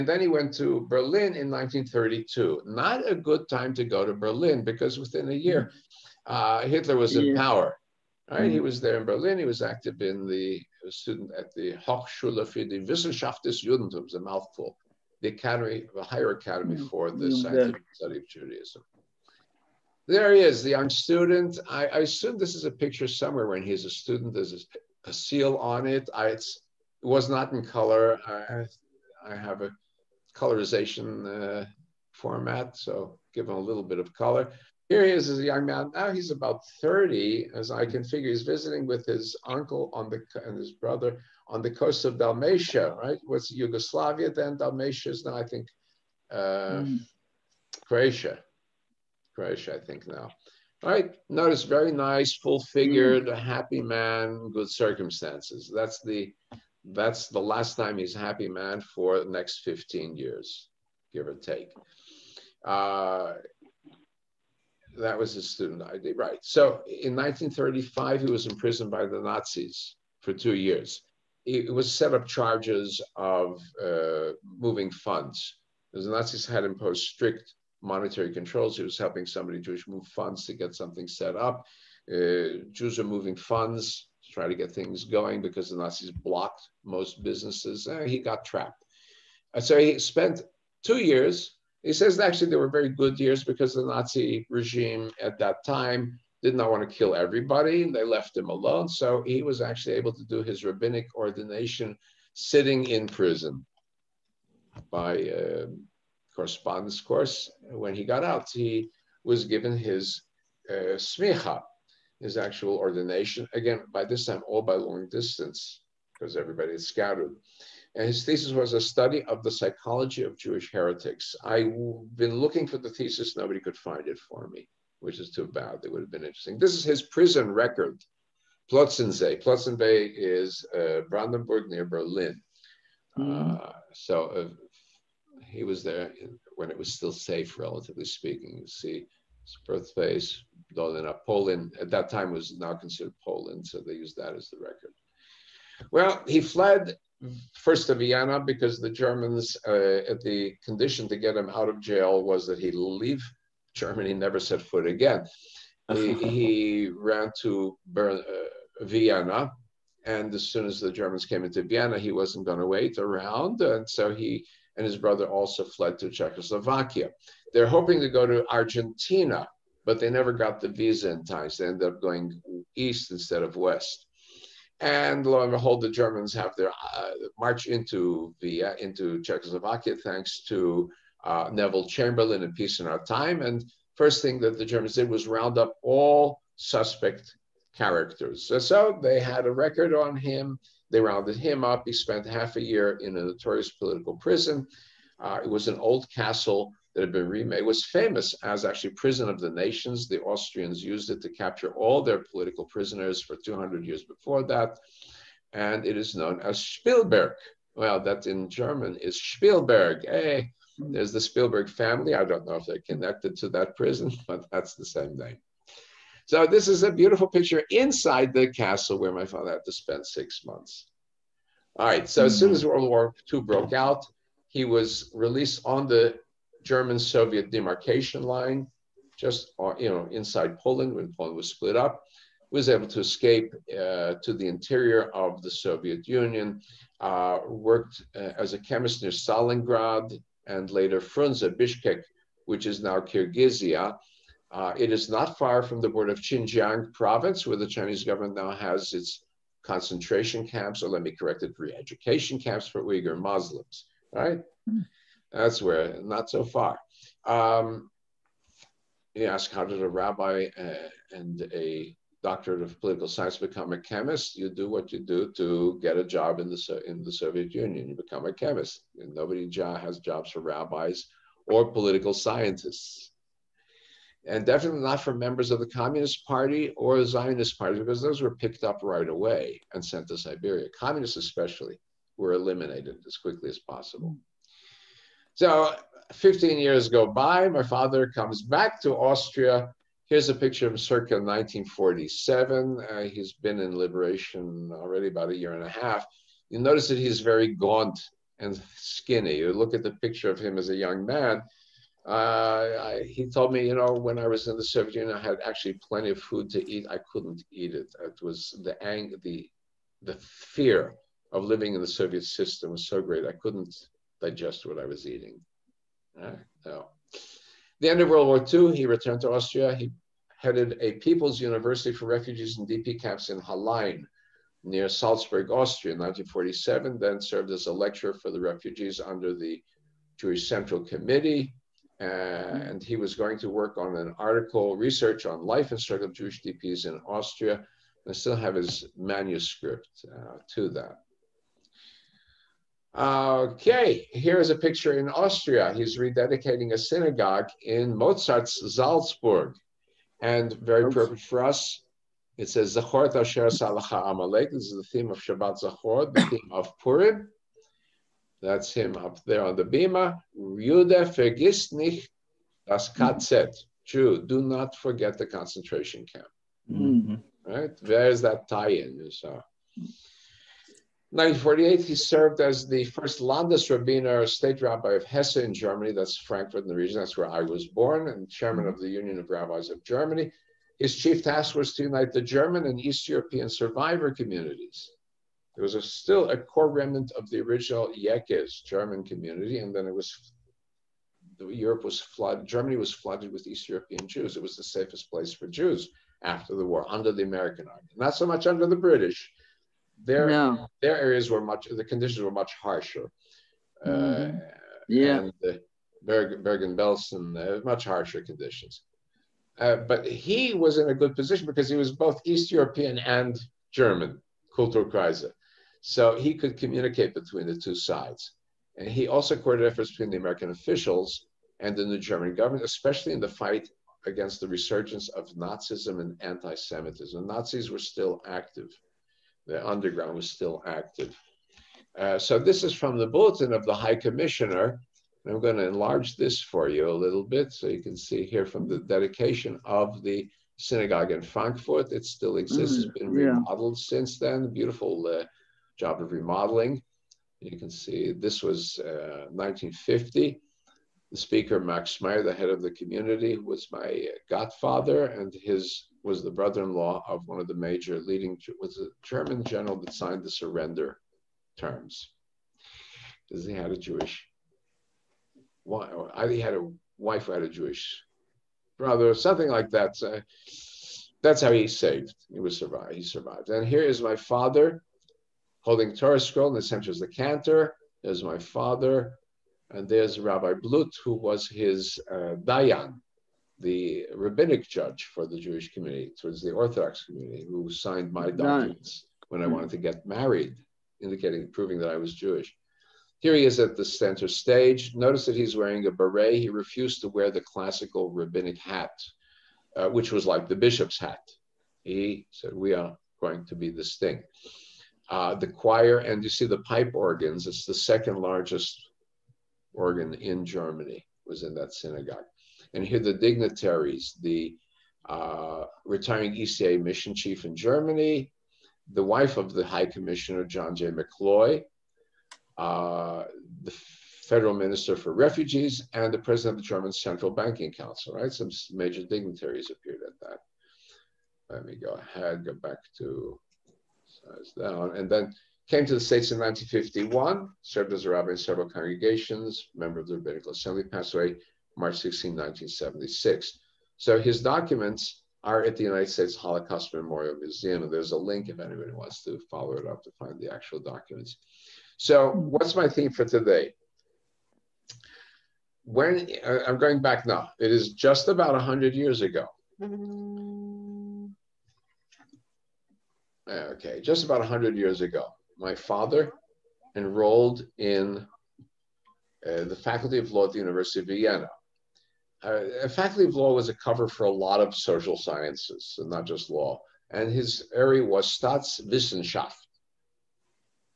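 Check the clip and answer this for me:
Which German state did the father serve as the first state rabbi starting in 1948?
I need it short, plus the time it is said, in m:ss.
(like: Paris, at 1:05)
Hesse, at 6:15.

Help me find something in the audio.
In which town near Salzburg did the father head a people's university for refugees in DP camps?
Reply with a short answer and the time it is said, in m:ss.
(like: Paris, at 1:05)
Hallein, at 5:23.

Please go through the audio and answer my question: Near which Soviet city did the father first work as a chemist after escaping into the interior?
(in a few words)
Stalingrad.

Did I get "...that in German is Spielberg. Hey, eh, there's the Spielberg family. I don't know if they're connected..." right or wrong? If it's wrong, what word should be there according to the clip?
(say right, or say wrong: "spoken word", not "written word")
right.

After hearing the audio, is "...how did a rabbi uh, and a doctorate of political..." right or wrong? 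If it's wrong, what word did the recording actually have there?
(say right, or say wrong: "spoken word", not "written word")
right.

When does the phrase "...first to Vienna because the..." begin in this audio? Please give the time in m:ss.
2:27.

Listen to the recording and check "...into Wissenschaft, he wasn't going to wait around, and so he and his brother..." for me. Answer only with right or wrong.
wrong.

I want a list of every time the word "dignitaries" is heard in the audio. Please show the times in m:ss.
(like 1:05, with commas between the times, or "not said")
8:33, 8:49.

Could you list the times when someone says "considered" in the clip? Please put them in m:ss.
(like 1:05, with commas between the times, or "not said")
2:22.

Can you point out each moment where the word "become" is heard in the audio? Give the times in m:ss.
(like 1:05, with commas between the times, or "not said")
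4:23, 4:27.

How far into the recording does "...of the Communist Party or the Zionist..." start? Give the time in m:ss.
4:35.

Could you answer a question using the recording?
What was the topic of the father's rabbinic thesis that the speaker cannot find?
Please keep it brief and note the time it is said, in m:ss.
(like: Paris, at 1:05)
Psychology of Jewish heretics, at 1:59.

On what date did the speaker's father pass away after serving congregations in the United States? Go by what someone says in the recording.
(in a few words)
March 16, 1976.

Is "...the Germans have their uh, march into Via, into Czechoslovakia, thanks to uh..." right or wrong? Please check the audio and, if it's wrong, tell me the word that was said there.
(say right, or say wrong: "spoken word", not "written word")
right.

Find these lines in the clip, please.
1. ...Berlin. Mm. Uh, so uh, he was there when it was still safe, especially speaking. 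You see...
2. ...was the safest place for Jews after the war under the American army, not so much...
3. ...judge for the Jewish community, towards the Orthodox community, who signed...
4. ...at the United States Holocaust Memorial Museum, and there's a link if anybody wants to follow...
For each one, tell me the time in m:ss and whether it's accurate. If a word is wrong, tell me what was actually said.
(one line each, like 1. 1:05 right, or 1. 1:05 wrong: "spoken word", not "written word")
1. 2:11 wrong: "relatively", not "especially"
2. 6:34 right
3. 8:04 right
4. 9:05 right.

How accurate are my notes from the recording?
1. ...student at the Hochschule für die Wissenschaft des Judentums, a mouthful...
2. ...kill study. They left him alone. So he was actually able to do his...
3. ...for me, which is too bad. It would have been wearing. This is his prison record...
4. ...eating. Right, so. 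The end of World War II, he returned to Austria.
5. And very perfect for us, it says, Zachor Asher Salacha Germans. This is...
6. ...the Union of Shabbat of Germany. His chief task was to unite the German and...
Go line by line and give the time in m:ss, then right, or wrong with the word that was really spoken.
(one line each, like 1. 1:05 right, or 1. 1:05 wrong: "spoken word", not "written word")
1. 0:10 right
2. 1:36 wrong: "everybody", not "study"
3. 2:04 wrong: "interesting", not "wearing"
4. 5:15 right
5. 5:50 wrong: "Amalek", not "Germans"
6. 6:18 wrong: "Rabbis", not "Shabbat".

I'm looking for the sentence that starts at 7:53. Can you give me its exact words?
And here is my father holding Torah scroll in the center is the cantor.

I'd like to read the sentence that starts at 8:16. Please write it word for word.
He refused to wear the classical rabbinic hat, uh, which was like the bishop's hat.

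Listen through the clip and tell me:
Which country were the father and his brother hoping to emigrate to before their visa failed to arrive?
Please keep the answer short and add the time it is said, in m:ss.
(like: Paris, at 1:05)
Argentina, at 2:48.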